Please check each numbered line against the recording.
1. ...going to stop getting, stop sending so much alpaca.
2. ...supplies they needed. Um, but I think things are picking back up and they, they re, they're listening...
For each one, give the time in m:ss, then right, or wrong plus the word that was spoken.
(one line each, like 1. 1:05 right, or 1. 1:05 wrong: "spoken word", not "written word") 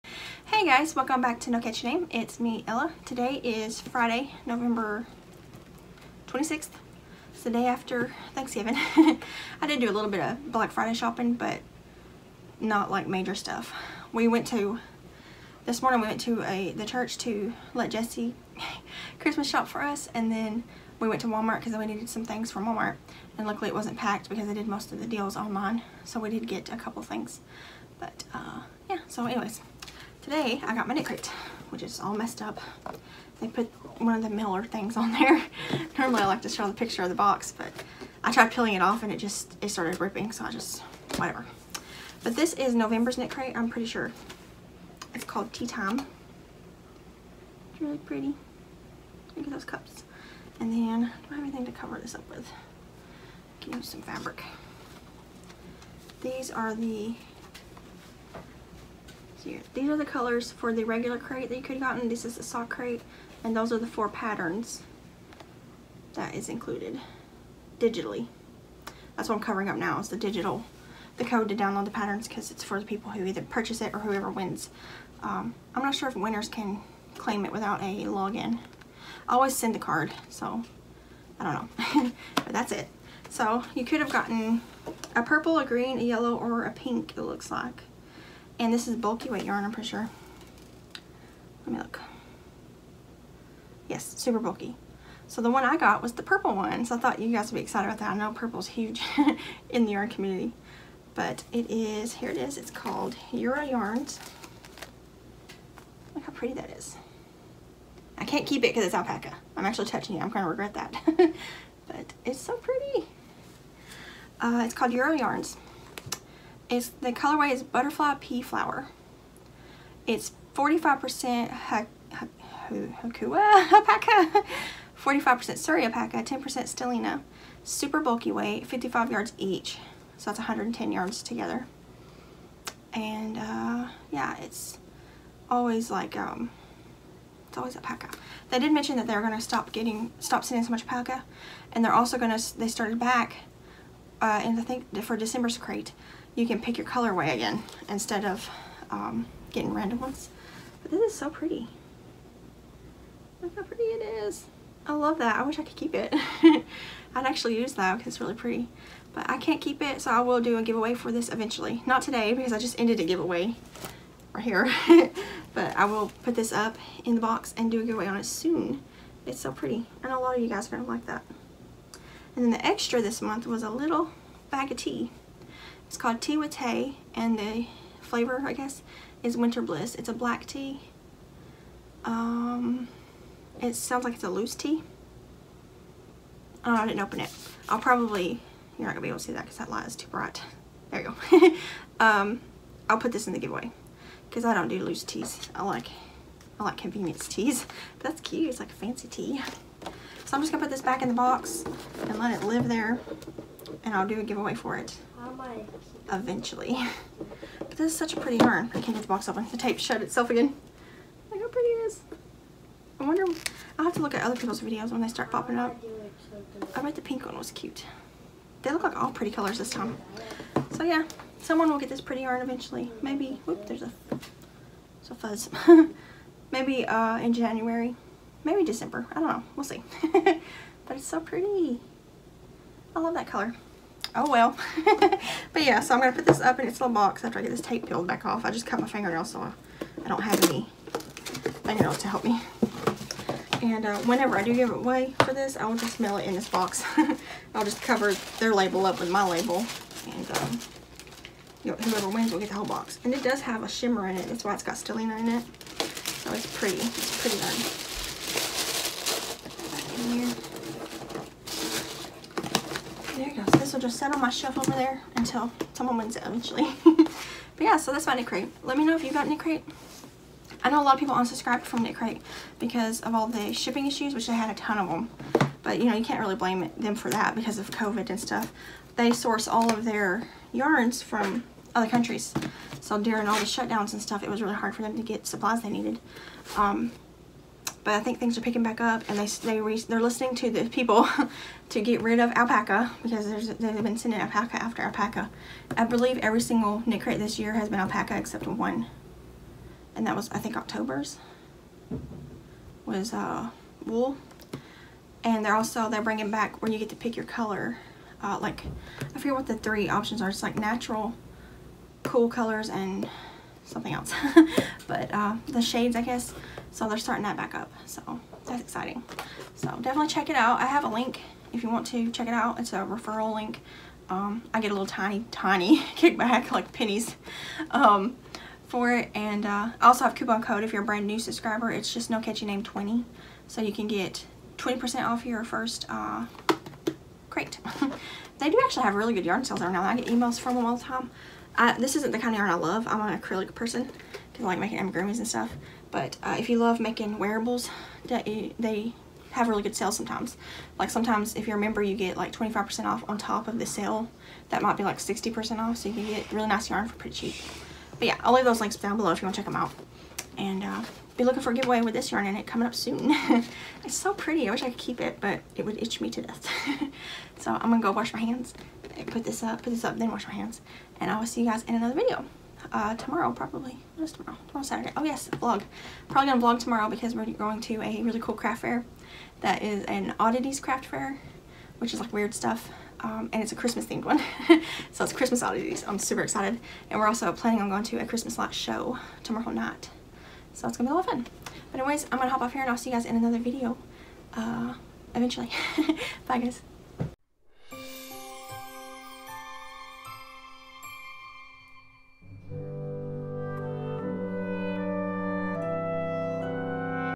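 1. 2:19 right
2. 4:45 right.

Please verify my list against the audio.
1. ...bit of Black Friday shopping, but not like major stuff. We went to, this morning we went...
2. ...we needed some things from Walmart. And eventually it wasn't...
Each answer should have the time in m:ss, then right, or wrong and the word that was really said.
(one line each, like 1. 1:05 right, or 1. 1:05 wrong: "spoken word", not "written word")
1. 0:10 right
2. 0:21 wrong: "luckily", not "eventually".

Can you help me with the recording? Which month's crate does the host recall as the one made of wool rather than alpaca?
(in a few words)
October.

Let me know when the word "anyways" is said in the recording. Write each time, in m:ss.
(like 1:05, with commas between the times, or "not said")
0:29, 6:31.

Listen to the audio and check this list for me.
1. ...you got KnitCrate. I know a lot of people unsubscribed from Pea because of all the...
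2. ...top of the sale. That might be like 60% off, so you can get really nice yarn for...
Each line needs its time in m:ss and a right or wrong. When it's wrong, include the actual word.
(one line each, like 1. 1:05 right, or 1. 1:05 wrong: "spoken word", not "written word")
1. 4:29 wrong: "KnitCrate", not "Pea"
2. 5:53 right.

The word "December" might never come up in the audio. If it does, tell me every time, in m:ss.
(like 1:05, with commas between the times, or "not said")
2:25, 3:48.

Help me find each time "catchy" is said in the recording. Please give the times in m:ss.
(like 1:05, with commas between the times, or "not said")
0:01, 5:32.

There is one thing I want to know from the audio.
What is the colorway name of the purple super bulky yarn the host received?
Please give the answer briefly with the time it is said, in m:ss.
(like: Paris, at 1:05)
Butterfly Pea Flower, at 1:57.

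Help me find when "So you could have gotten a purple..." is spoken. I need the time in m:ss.
1:23.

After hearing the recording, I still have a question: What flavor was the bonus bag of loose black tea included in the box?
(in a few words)
Winter Bliss.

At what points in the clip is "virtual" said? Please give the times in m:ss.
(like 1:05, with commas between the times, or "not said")
not said.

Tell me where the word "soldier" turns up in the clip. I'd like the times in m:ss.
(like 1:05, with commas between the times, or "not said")
not said.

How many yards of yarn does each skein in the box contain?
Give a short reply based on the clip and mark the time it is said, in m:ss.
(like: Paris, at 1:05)
55 yards, at 2:08.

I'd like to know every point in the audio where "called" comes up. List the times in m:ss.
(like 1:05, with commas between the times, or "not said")
0:45, 1:42, 1:54, 2:55.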